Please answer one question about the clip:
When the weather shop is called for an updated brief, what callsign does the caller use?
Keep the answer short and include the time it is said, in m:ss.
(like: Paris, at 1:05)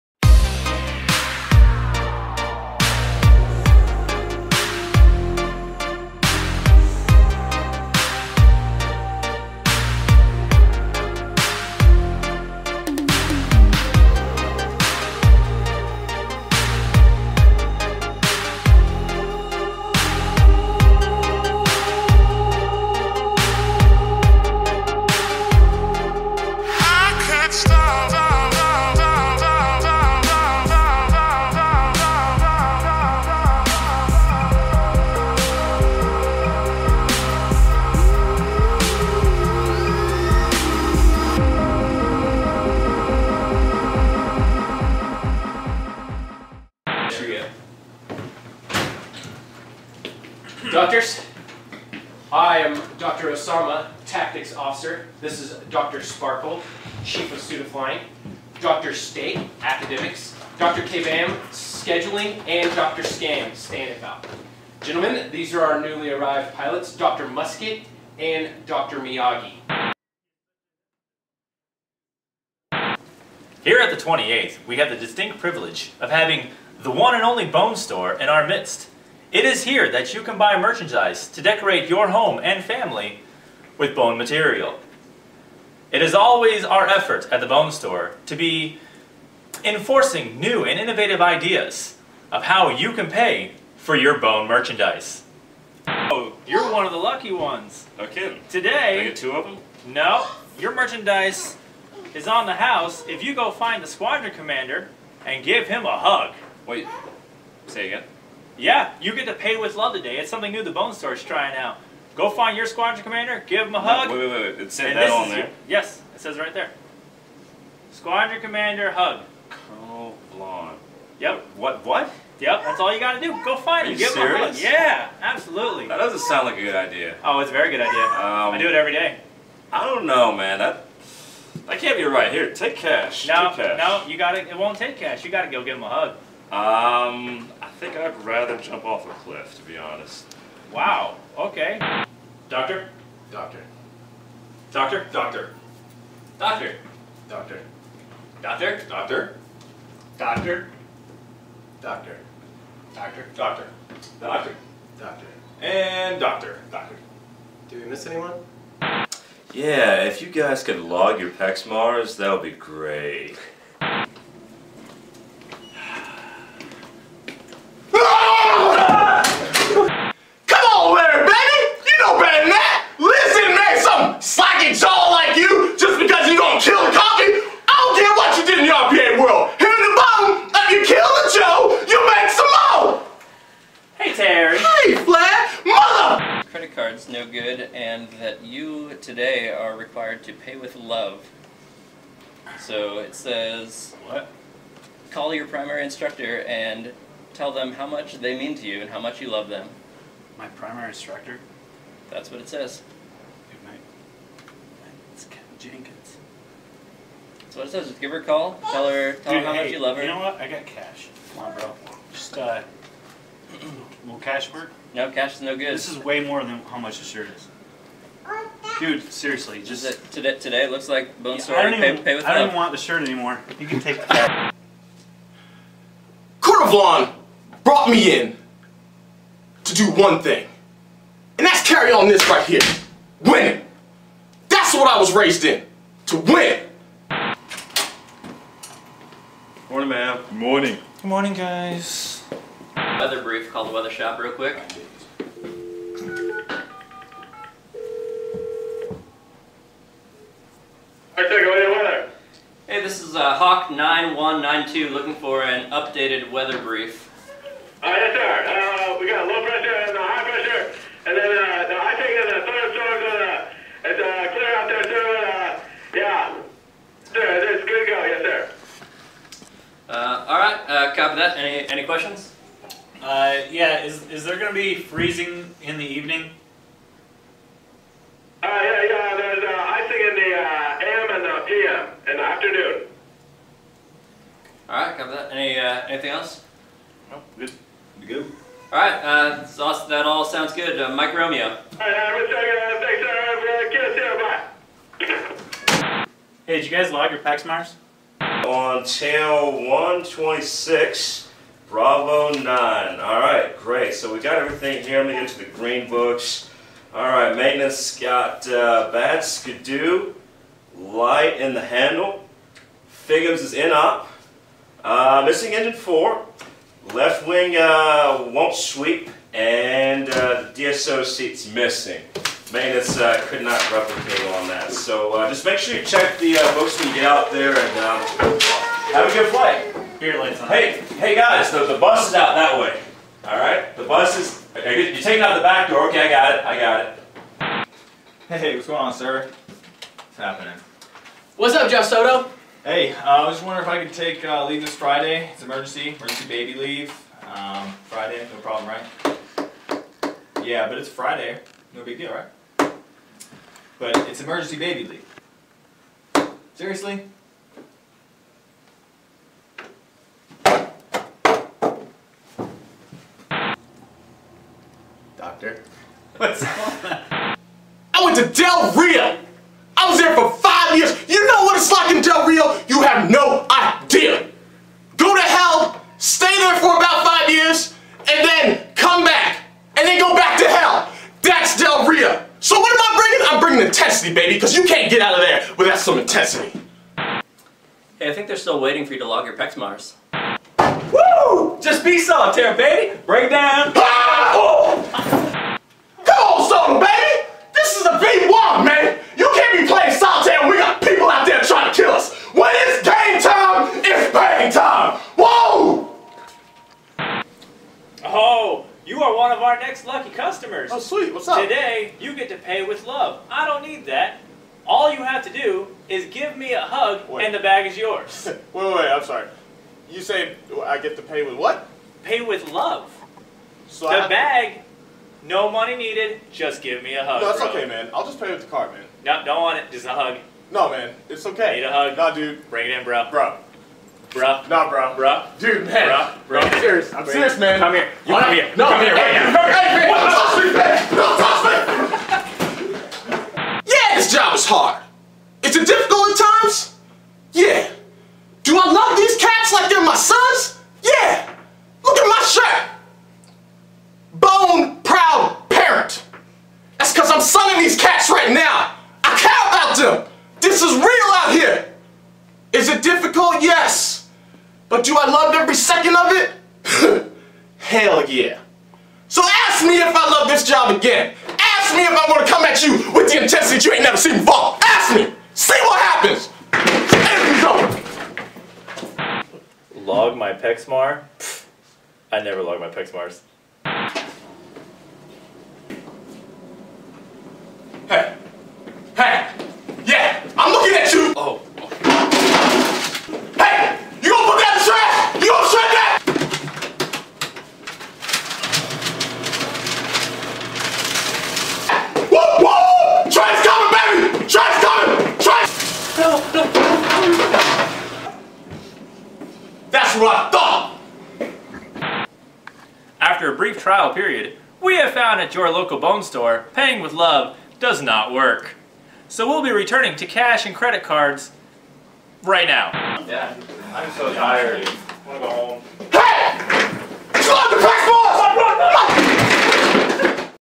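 Hawk 9192, at 4:13.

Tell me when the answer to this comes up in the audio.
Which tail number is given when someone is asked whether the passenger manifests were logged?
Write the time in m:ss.
4:59.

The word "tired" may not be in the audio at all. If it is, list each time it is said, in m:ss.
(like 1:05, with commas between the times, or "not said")
8:44.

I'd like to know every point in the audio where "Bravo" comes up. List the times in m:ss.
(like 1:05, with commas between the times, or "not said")
5:01.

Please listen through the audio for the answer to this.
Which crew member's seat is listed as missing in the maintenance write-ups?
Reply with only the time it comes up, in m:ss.
5:20.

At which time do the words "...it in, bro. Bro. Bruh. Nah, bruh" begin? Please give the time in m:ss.
7:12.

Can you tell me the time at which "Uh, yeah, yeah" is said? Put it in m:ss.
4:38.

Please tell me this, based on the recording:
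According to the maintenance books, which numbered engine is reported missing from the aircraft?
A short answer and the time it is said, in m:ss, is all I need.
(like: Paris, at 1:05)
engine 4, at 5:15.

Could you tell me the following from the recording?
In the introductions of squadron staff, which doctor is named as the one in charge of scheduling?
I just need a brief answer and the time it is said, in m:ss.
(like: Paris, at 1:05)
Dr. Kabam, at 1:00.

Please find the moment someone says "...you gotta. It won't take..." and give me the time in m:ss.
2:14.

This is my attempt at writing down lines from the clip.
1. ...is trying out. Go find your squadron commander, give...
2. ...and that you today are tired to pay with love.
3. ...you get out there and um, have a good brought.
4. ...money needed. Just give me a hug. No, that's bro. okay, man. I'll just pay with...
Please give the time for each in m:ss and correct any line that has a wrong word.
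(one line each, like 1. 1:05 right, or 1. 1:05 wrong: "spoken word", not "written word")
1. 1:51 right
2. 3:07 wrong: "required", not "tired"
3. 5:26 wrong: "flight", not "brought"
4. 7:05 right.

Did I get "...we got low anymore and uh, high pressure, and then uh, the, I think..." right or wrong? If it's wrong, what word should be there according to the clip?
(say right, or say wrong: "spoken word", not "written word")
wrong: "pressure", not "anymore".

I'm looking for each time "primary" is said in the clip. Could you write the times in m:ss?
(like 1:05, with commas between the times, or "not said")
3:15, 3:20.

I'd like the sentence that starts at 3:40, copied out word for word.
Today looks like bone yeah, I don't, even, pay, pay I don't want the shirt anymore.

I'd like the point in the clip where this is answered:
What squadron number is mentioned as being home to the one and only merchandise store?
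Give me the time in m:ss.
1:13.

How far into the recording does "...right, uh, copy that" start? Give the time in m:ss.
4:30.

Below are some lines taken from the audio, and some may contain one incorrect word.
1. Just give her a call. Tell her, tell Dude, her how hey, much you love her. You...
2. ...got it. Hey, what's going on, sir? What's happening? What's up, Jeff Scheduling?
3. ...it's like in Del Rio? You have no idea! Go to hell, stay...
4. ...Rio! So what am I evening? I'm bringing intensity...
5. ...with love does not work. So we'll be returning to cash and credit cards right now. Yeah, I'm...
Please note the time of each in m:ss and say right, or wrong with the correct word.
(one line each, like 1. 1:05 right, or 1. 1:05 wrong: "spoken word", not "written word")
1. 3:27 right
2. 5:36 wrong: "Soto", not "Scheduling"
3. 6:11 right
4. 6:21 wrong: "bringing", not "evening"
5. 8:36 right.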